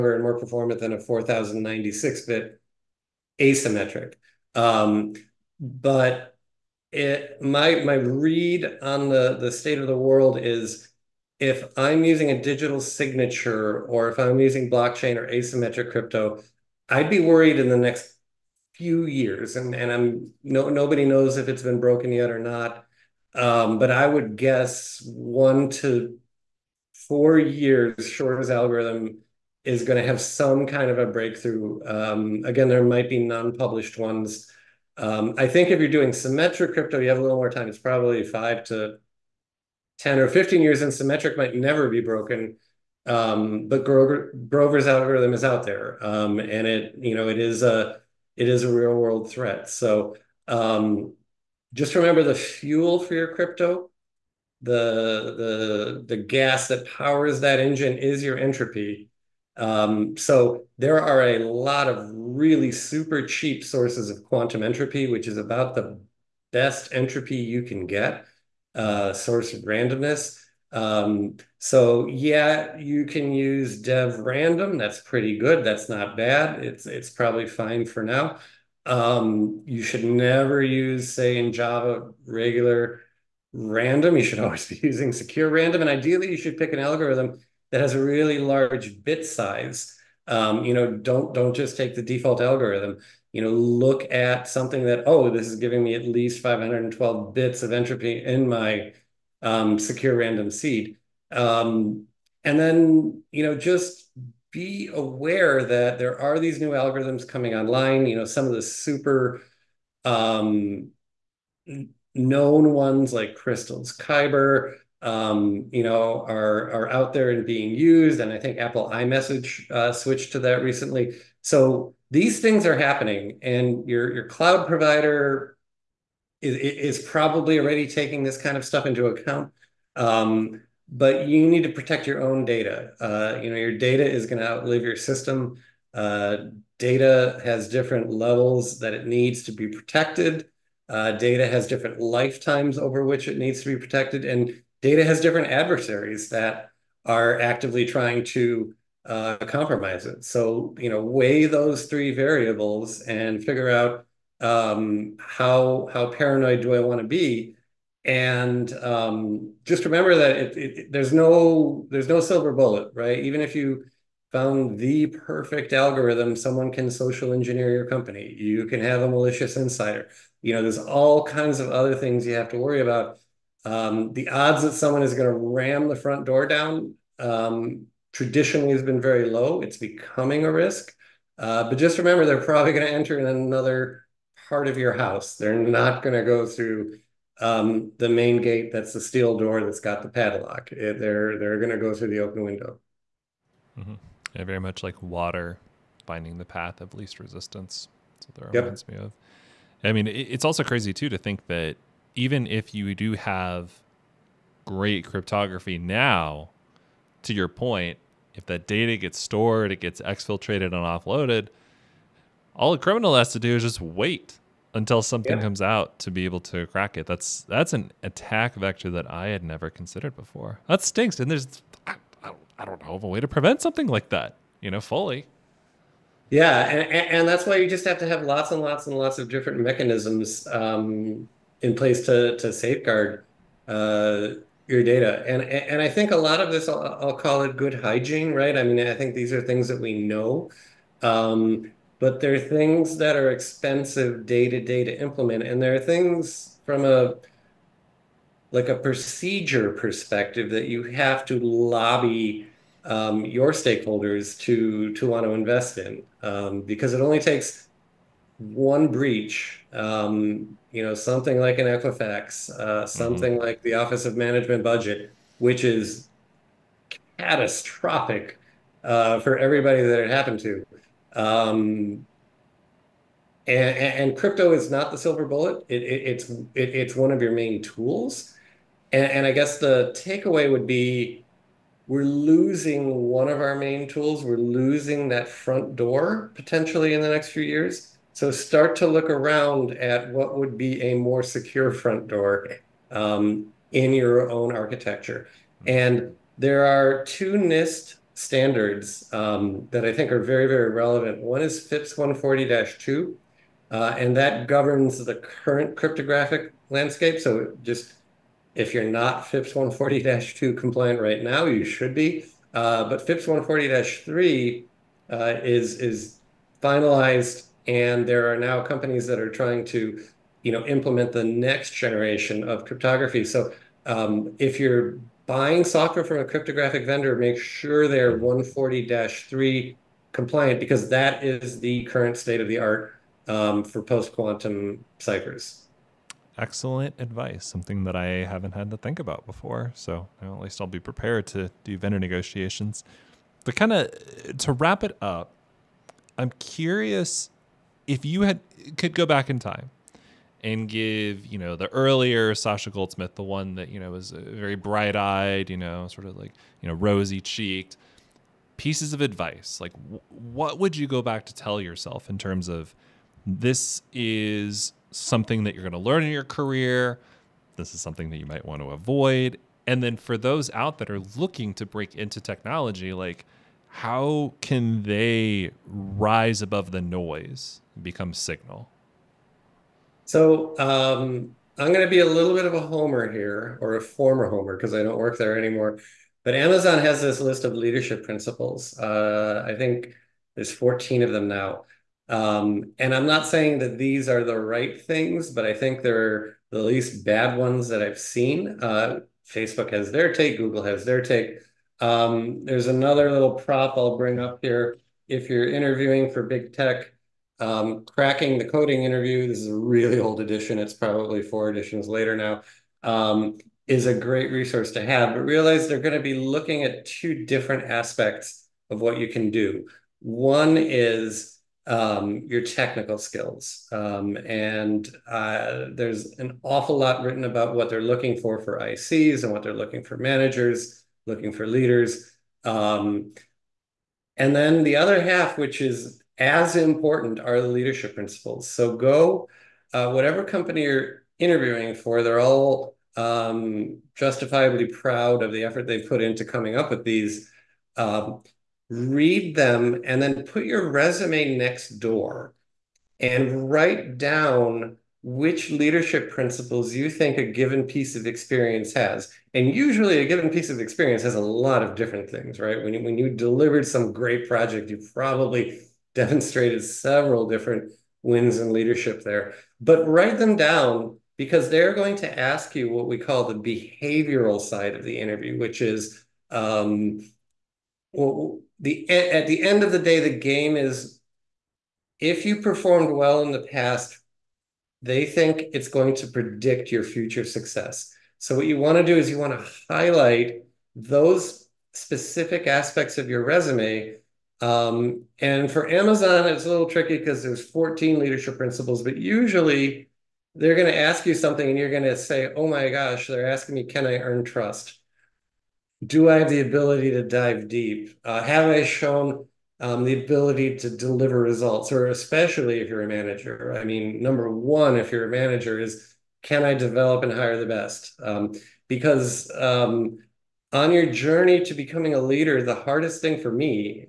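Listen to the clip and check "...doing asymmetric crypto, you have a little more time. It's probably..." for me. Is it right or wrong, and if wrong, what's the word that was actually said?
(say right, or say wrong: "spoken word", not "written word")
wrong: "symmetric", not "asymmetric".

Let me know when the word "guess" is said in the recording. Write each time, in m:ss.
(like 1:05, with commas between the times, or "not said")
0:24, 4:39.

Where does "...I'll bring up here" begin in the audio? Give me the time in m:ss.
6:43.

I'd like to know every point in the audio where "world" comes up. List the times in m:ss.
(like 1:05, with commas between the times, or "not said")
0:09, 0:48.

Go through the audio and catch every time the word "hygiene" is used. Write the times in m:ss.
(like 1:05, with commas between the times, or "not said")
3:57.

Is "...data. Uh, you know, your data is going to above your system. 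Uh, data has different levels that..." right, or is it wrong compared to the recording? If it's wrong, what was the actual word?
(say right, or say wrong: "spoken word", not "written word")
wrong: "outlive", not "above".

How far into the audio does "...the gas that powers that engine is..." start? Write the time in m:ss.
0:56.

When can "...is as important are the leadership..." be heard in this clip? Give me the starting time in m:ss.
7:15.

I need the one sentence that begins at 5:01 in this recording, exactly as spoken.
One is FIPS 140-2, uh, and that governs the current cryptographic landscape.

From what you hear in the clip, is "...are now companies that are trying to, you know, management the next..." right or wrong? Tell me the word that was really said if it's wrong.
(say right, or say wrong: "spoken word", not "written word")
wrong: "implement", not "management".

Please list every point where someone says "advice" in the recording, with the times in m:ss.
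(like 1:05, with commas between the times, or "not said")
5:36, 5:59.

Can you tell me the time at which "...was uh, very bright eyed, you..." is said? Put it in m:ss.
5:53.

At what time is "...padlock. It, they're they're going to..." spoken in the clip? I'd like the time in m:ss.
3:10.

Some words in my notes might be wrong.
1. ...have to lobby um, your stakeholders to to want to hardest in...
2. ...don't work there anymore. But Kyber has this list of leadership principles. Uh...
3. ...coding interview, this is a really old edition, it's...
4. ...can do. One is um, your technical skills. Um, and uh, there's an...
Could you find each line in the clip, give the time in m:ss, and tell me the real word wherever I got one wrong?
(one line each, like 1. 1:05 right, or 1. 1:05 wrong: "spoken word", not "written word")
1. 4:10 wrong: "invest", not "hardest"
2. 6:24 wrong: "Amazon", not "Kyber"
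3. 6:48 right
4. 6:59 right.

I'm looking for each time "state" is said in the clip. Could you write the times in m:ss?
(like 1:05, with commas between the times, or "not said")
0:09, 5:32.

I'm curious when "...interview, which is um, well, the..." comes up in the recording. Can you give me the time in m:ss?
7:54.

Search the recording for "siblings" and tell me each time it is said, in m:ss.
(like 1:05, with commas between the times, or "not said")
not said.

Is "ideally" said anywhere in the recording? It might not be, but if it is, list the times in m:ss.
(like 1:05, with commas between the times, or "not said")
1:25.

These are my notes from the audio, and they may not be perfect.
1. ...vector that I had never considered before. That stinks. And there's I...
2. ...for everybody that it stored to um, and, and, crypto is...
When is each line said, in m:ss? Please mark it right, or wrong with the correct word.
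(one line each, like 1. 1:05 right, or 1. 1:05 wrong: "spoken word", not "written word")
1. 3:38 right
2. 4:29 wrong: "happened", not "stored".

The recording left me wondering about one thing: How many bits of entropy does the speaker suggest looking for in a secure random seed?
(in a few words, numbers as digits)
512.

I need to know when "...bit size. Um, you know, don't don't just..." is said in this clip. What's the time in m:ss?
1:29.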